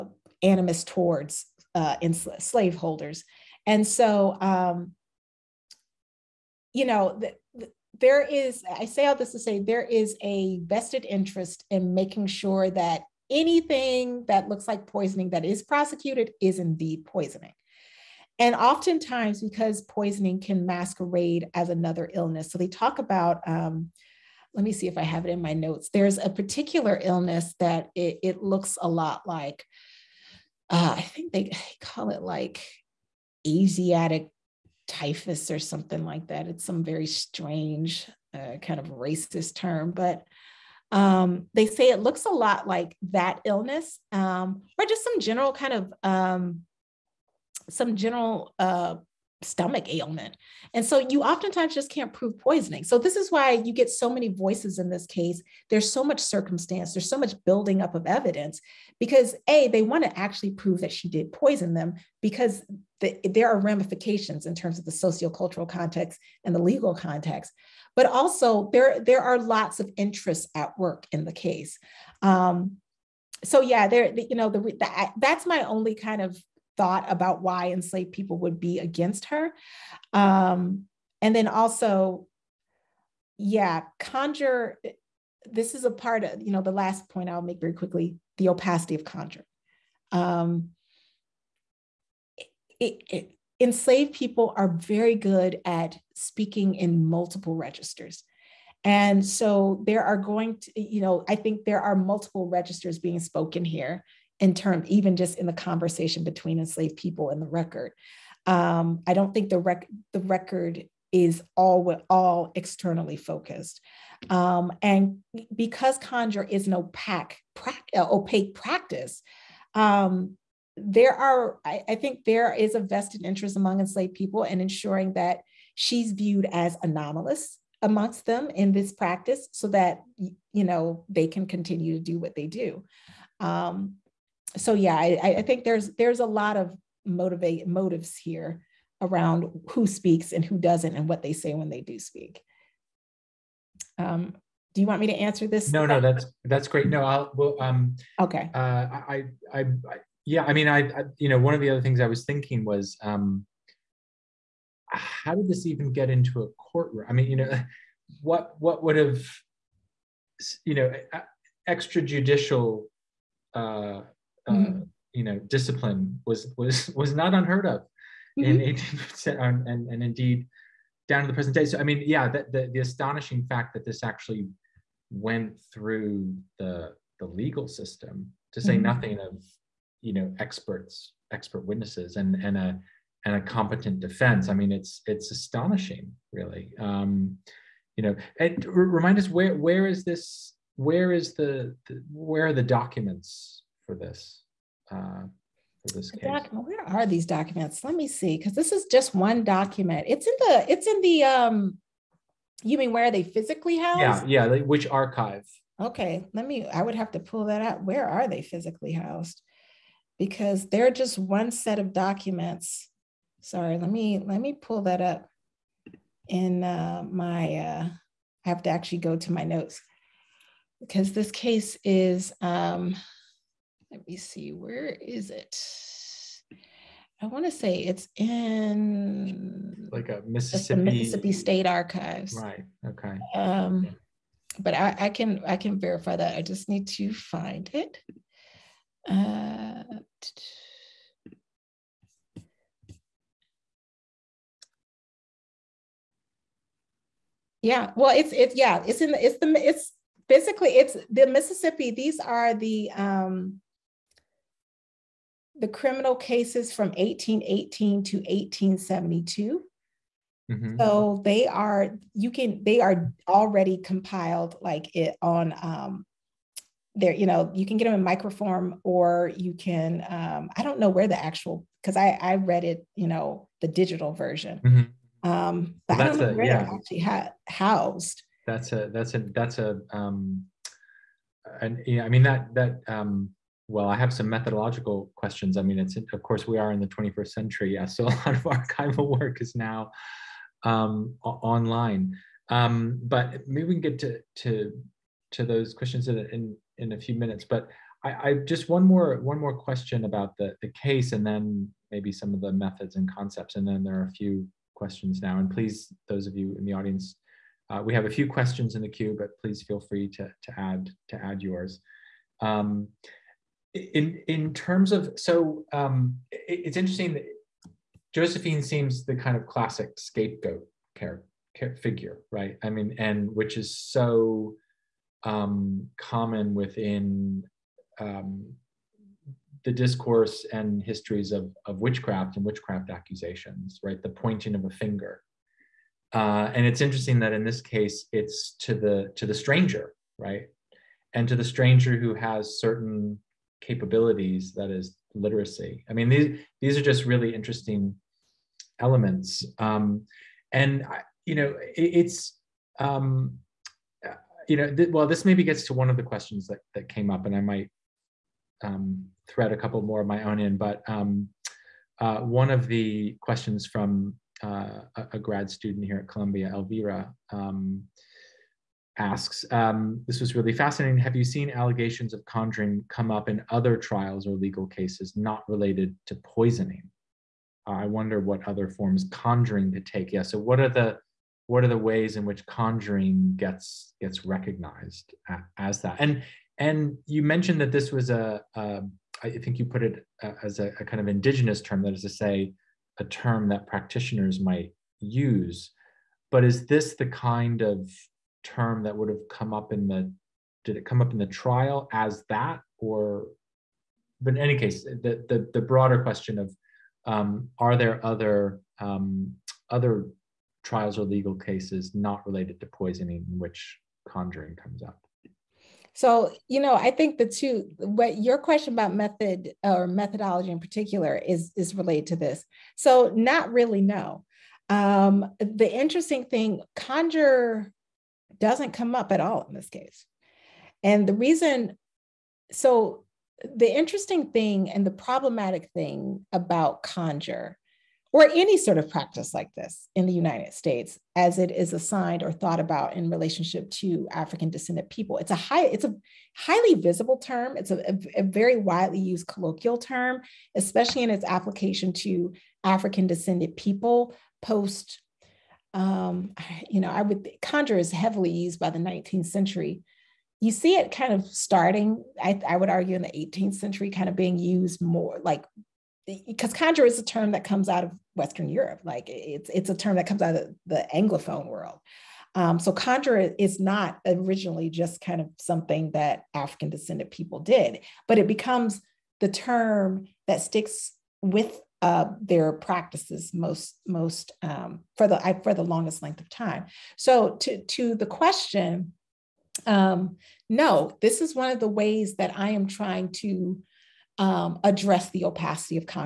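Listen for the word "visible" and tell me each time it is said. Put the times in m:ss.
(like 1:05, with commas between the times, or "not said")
7:26.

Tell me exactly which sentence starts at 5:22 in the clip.
I mean, and which is so um, common within um, the discourse and histories of, of witchcraft and witchcraft accusations, right?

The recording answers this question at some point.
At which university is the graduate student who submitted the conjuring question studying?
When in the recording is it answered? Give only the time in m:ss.
6:06.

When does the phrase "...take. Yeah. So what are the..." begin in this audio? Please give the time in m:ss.
6:19.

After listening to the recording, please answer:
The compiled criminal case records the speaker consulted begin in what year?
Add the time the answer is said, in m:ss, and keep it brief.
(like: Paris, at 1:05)
1818, at 4:16.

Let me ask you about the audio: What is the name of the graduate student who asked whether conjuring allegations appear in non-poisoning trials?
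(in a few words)
Elvira.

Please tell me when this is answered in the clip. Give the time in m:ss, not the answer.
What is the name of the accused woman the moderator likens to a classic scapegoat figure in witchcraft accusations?
5:18.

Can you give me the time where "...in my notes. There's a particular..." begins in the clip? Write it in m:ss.
0:25.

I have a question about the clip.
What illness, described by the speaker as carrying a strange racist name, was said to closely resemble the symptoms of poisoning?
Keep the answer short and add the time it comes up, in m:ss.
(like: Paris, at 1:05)
Asiatic typhus, at 0:33.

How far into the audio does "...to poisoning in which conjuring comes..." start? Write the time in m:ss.
6:52.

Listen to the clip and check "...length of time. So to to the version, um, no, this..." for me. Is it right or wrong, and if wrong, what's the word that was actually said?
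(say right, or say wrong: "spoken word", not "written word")
wrong: "question", not "version".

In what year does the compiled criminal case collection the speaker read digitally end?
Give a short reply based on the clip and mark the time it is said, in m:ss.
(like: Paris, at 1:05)
1872, at 4:18.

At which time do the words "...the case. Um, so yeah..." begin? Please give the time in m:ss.
1:11.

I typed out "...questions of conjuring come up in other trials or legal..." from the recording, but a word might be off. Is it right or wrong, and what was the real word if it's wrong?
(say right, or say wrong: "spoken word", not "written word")
wrong: "allegations", not "questions".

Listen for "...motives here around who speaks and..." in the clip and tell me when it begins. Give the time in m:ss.
2:17.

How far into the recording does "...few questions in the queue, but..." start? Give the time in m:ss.
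5:08.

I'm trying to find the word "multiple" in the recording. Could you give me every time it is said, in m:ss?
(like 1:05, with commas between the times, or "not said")
1:37, 1:41.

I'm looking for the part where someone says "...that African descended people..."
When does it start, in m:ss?
7:55.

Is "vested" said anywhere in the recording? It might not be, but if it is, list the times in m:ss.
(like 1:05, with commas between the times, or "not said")
0:10, 2:02.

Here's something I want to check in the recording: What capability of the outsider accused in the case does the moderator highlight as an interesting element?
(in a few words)
Literacy.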